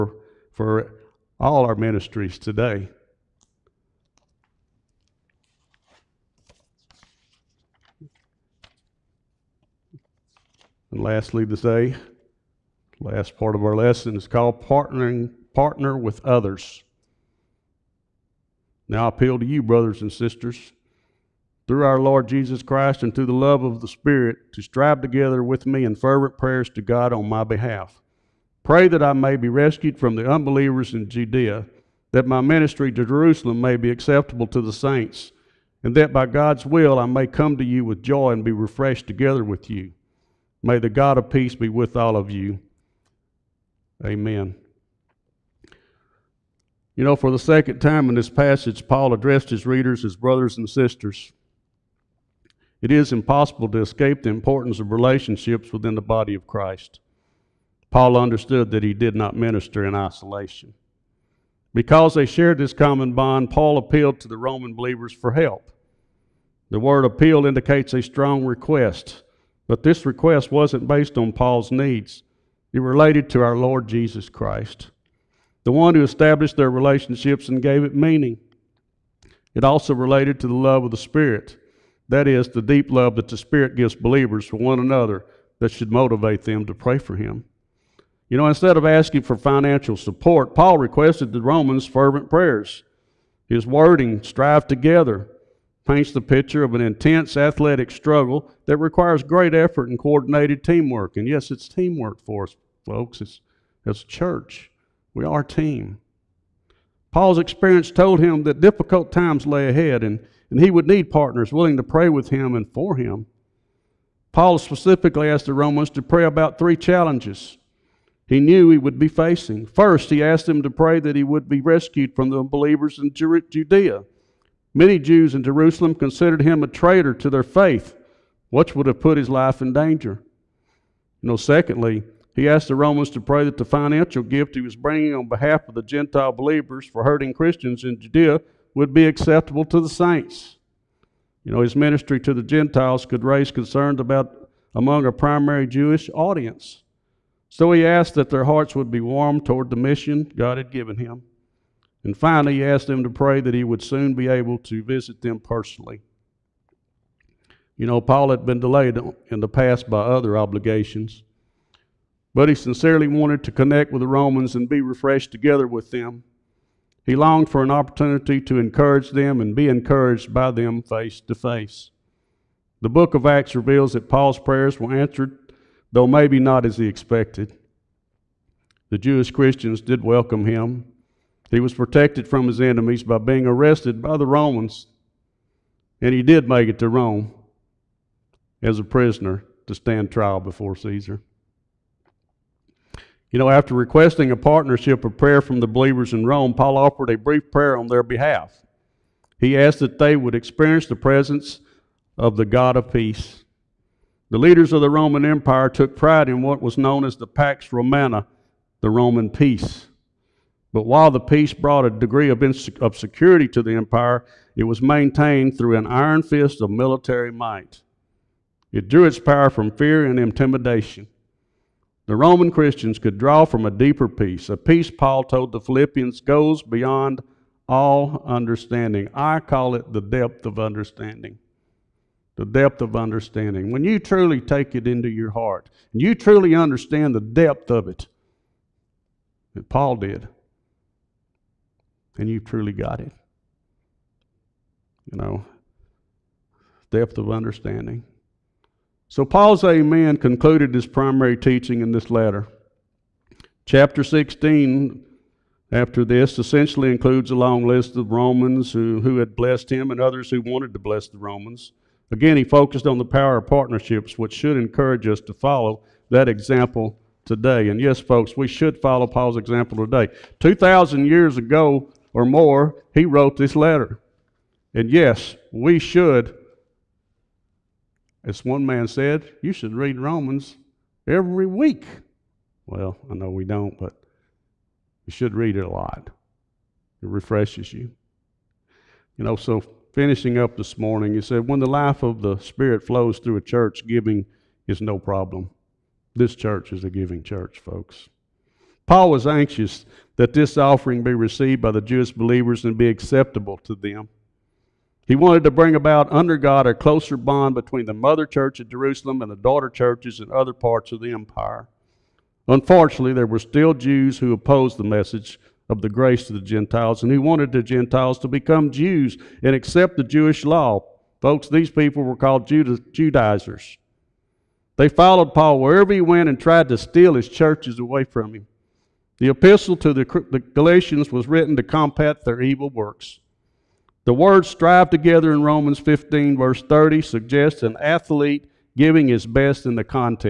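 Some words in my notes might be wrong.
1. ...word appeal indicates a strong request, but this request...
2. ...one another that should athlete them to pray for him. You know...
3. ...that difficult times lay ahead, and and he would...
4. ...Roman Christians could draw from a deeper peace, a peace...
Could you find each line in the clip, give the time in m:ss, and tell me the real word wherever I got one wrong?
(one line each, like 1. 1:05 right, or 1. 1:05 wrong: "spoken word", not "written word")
1. 1:06 right
2. 1:24 wrong: "motivate", not "athlete"
3. 1:48 right
4. 3:42 right.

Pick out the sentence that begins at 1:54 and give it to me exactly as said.
Paul specifically asked the Romans to pray about three challenges he knew he would be facing.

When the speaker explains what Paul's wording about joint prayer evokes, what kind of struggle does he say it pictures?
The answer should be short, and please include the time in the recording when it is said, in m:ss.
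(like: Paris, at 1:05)
Intense athletic struggle, at 1:36.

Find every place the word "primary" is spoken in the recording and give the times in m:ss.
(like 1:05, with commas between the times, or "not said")
2:25, 4:10.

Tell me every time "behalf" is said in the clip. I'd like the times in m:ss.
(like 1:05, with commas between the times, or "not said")
0:27, 2:15, 3:18.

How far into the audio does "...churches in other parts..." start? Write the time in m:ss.
5:09.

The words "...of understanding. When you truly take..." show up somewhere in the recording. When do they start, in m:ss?
3:52.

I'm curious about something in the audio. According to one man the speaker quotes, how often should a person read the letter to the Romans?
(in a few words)
Every week.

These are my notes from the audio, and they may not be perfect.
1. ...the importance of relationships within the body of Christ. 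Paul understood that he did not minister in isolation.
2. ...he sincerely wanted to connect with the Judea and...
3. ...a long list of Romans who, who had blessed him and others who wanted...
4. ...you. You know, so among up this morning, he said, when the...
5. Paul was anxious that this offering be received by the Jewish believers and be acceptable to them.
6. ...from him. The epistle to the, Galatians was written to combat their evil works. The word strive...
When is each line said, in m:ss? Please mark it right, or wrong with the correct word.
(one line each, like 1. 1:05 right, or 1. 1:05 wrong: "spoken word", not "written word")
1. 0:54 right
2. 2:42 wrong: "Romans", not "Judea"
3. 4:17 right
4. 4:47 wrong: "finishing", not "among"
5. 4:58 right
6. 5:28 right.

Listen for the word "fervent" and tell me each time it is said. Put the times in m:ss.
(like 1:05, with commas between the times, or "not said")
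0:25, 1:31.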